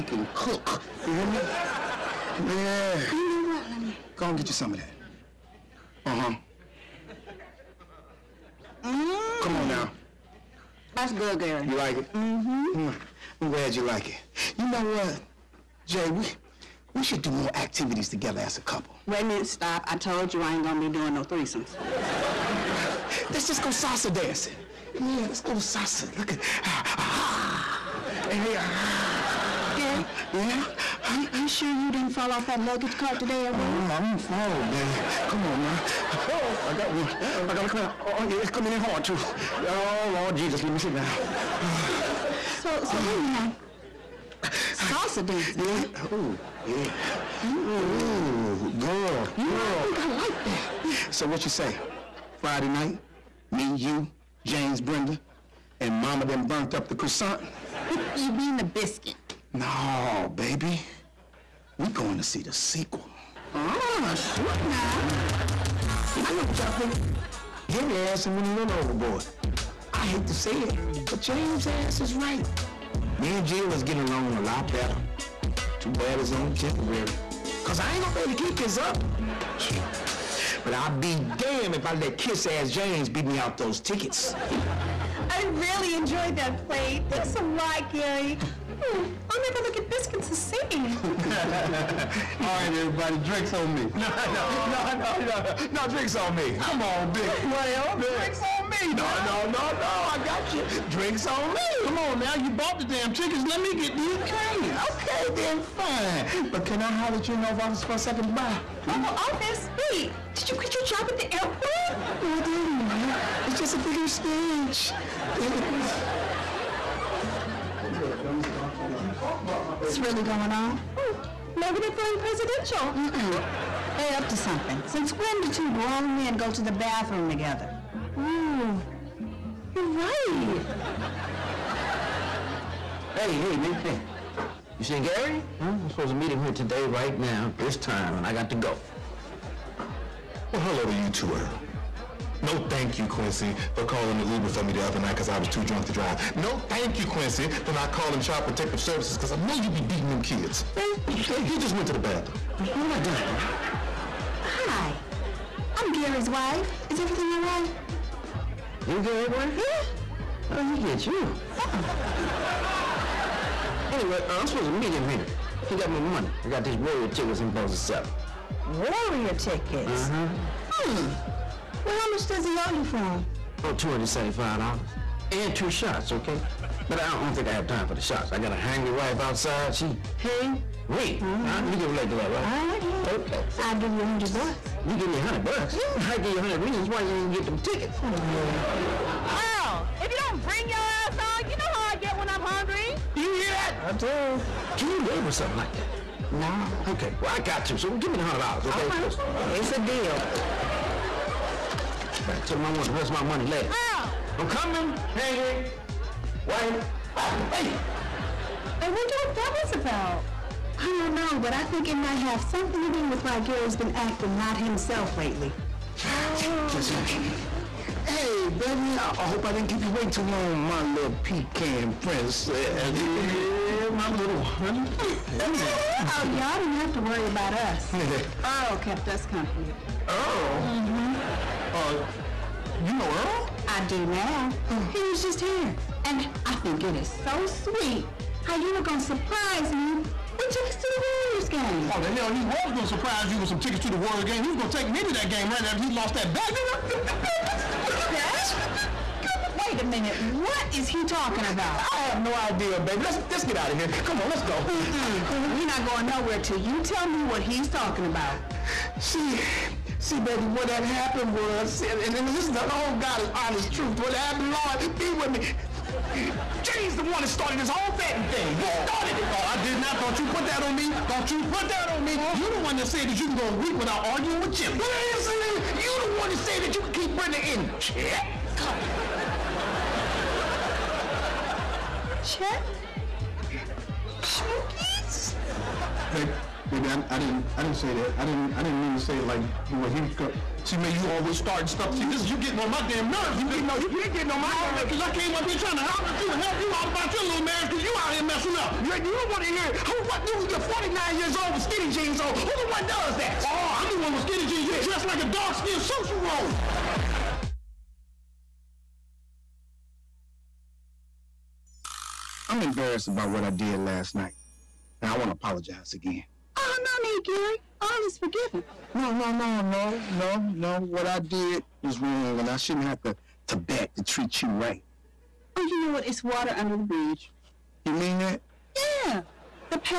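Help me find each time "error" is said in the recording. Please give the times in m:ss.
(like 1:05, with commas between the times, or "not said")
not said.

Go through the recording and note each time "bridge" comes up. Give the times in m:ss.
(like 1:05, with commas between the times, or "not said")
5:26.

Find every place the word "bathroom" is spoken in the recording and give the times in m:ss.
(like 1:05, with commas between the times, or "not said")
2:06, 2:31.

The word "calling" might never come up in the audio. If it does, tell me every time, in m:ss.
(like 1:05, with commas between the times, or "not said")
2:23, 2:27.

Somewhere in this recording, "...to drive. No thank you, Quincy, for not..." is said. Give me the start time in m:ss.
2:25.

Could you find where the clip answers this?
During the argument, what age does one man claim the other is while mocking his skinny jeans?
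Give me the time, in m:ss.
5:00.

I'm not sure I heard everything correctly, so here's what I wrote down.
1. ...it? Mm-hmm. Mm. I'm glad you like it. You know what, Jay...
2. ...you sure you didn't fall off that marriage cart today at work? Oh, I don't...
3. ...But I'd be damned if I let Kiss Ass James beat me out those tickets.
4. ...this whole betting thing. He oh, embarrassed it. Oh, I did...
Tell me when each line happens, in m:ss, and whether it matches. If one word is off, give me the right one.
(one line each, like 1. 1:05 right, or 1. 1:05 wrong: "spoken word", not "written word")
1. 0:11 right
2. 0:31 wrong: "luggage", not "marriage"
3. 1:20 right
4. 4:27 wrong: "started", not "embarrassed".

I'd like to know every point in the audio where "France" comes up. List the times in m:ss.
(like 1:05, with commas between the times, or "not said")
not said.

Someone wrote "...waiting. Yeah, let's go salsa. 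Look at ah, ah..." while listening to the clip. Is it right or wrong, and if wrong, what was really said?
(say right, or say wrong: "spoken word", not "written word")
wrong: "dancing", not "waiting".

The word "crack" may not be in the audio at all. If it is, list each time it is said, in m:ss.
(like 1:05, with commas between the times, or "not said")
not said.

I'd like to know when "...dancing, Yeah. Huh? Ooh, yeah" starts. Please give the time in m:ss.
0:45.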